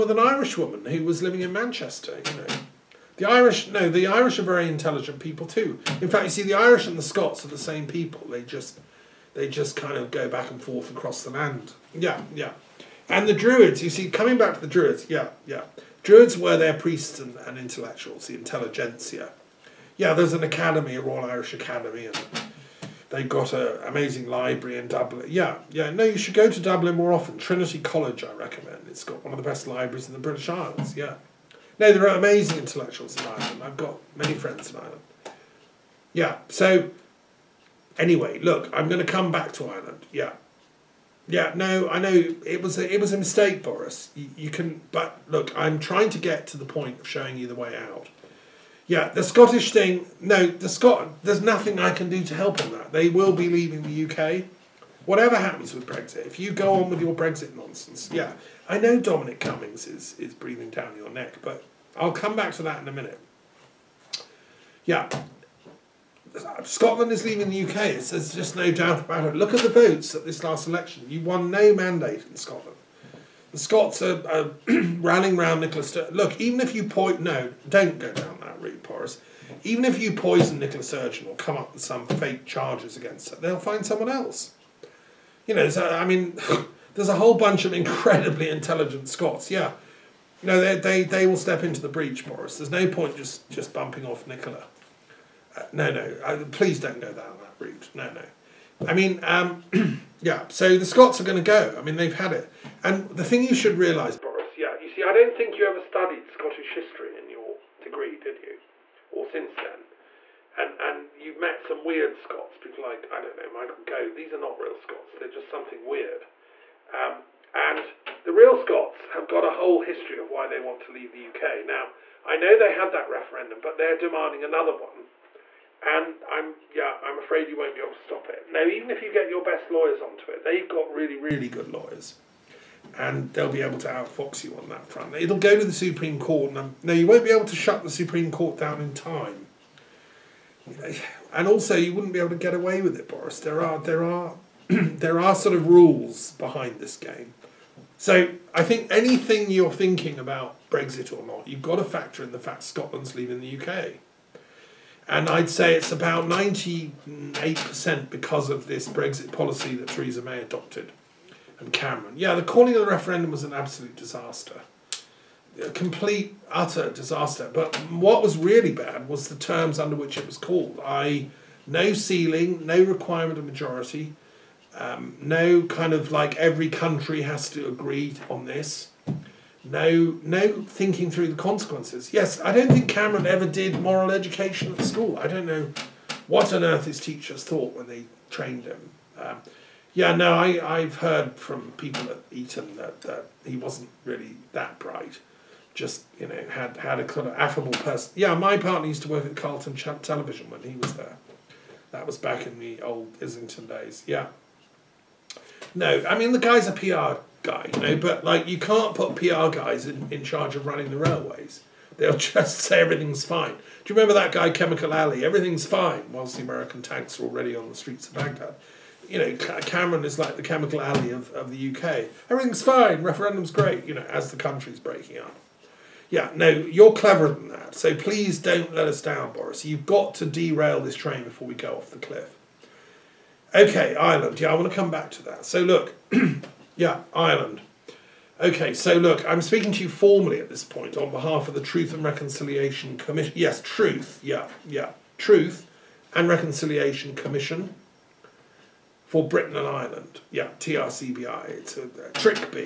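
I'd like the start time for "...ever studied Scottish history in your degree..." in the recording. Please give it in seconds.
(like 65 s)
105 s.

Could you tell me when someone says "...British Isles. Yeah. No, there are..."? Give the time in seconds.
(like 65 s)
30 s.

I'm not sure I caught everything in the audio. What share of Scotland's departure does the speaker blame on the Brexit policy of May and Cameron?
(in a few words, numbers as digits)
98%.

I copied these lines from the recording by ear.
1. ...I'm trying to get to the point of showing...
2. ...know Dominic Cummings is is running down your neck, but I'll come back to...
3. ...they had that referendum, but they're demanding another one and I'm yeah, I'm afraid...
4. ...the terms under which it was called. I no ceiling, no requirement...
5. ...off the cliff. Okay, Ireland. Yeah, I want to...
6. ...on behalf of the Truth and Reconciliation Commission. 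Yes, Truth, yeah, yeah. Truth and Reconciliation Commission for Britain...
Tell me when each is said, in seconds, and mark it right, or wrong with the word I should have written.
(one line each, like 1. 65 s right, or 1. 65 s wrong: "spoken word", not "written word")
1. 45 s right
2. 58 s wrong: "breathing", not "running"
3. 122 s right
4. 169 s right
5. 231 s right
6. 240 s right.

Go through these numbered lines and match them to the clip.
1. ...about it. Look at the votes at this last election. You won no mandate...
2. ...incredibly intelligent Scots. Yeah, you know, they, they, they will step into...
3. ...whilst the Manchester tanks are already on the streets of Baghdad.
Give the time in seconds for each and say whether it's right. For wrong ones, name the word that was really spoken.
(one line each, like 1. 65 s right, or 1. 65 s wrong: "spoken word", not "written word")
1. 68 s right
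2. 87 s right
3. 216 s wrong: "American", not "Manchester".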